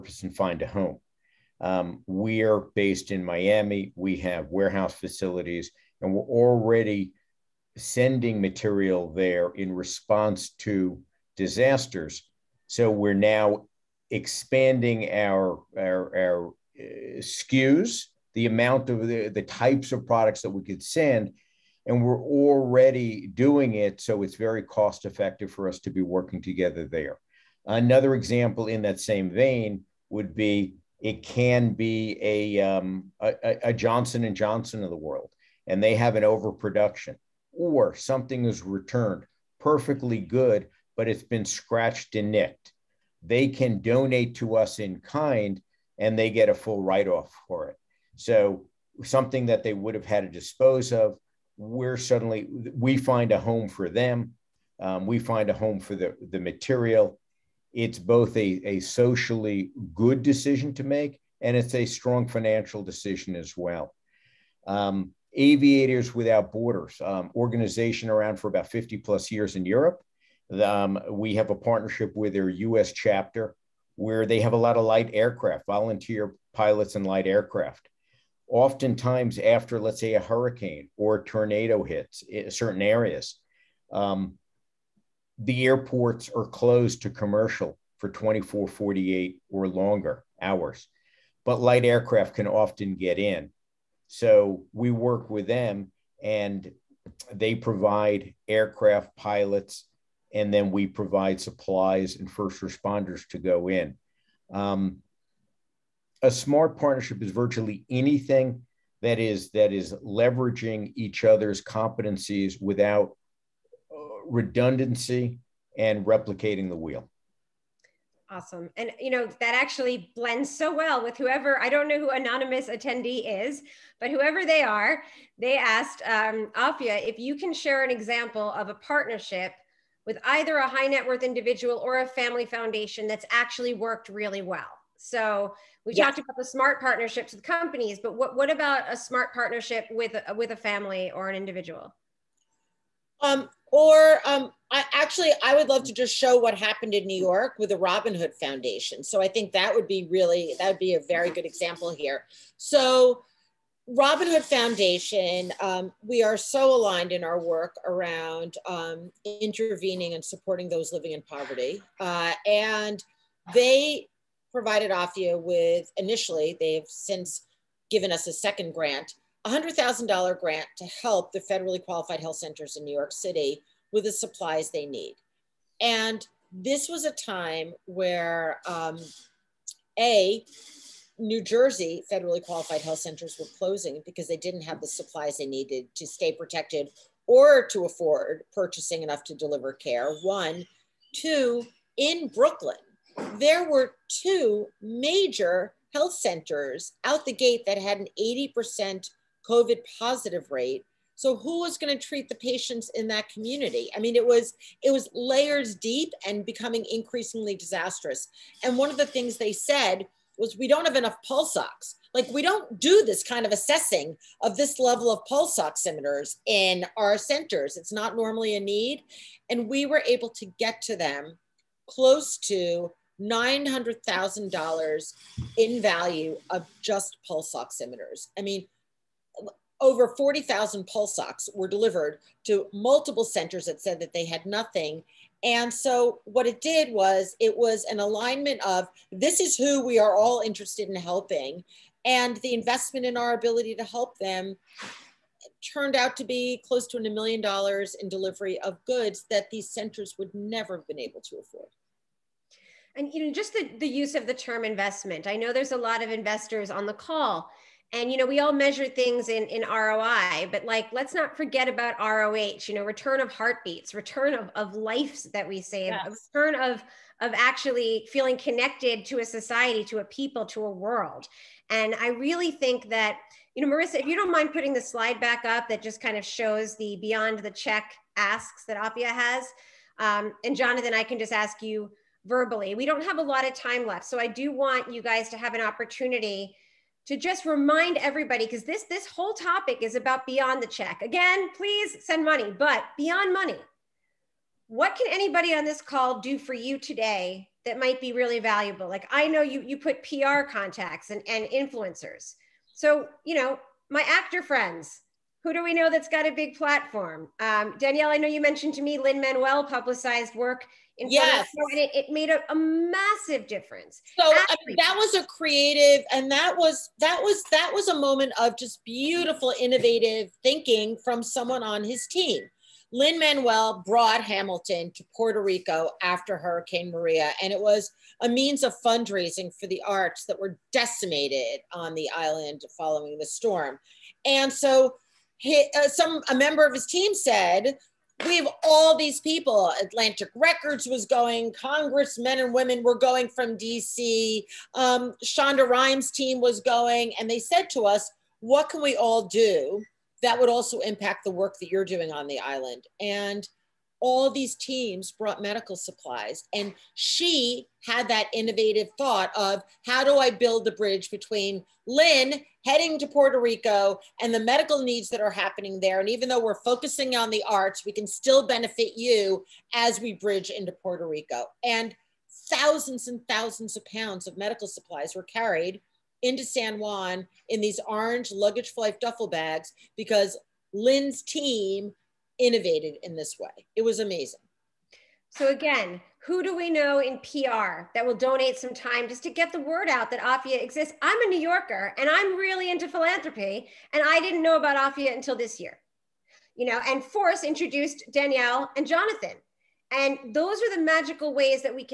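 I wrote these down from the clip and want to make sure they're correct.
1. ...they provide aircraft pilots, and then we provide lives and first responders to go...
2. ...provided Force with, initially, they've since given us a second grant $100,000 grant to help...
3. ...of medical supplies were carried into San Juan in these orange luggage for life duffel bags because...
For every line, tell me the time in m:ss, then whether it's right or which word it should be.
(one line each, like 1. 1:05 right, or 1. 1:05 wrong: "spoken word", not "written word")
1. 1:37 wrong: "supplies", not "lives"
2. 2:44 wrong: "AFYA", not "Force"
3. 6:14 right.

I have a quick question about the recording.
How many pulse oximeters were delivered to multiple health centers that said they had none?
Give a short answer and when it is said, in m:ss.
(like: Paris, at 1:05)
over 40,000, at 3:49.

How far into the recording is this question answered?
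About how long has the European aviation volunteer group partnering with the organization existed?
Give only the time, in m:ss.
1:08.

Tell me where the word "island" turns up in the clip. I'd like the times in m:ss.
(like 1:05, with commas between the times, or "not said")
5:32, 5:52.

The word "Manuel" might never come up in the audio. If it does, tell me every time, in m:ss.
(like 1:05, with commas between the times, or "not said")
5:08, 5:22.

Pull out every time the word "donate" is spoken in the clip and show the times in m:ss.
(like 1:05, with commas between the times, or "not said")
0:43, 6:28.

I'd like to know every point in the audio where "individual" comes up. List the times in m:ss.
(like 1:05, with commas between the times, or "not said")
2:11, 2:21.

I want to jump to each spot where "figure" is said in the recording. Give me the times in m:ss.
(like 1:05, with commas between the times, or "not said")
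not said.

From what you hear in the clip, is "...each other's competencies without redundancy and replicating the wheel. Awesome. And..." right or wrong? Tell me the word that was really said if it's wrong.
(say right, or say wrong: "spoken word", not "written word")
right.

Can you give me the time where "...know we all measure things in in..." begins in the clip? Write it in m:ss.
4:18.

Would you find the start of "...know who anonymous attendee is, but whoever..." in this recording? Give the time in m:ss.
2:01.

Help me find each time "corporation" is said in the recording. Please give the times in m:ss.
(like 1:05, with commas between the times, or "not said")
not said.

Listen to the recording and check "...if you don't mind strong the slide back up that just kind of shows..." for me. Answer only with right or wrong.
wrong.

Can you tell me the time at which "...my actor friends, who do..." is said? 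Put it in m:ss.
5:03.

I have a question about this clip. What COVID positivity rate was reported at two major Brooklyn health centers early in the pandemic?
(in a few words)
80%.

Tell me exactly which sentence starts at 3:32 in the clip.
Like we don't do this kind of assessing of this level of pulse oximeters in our centers.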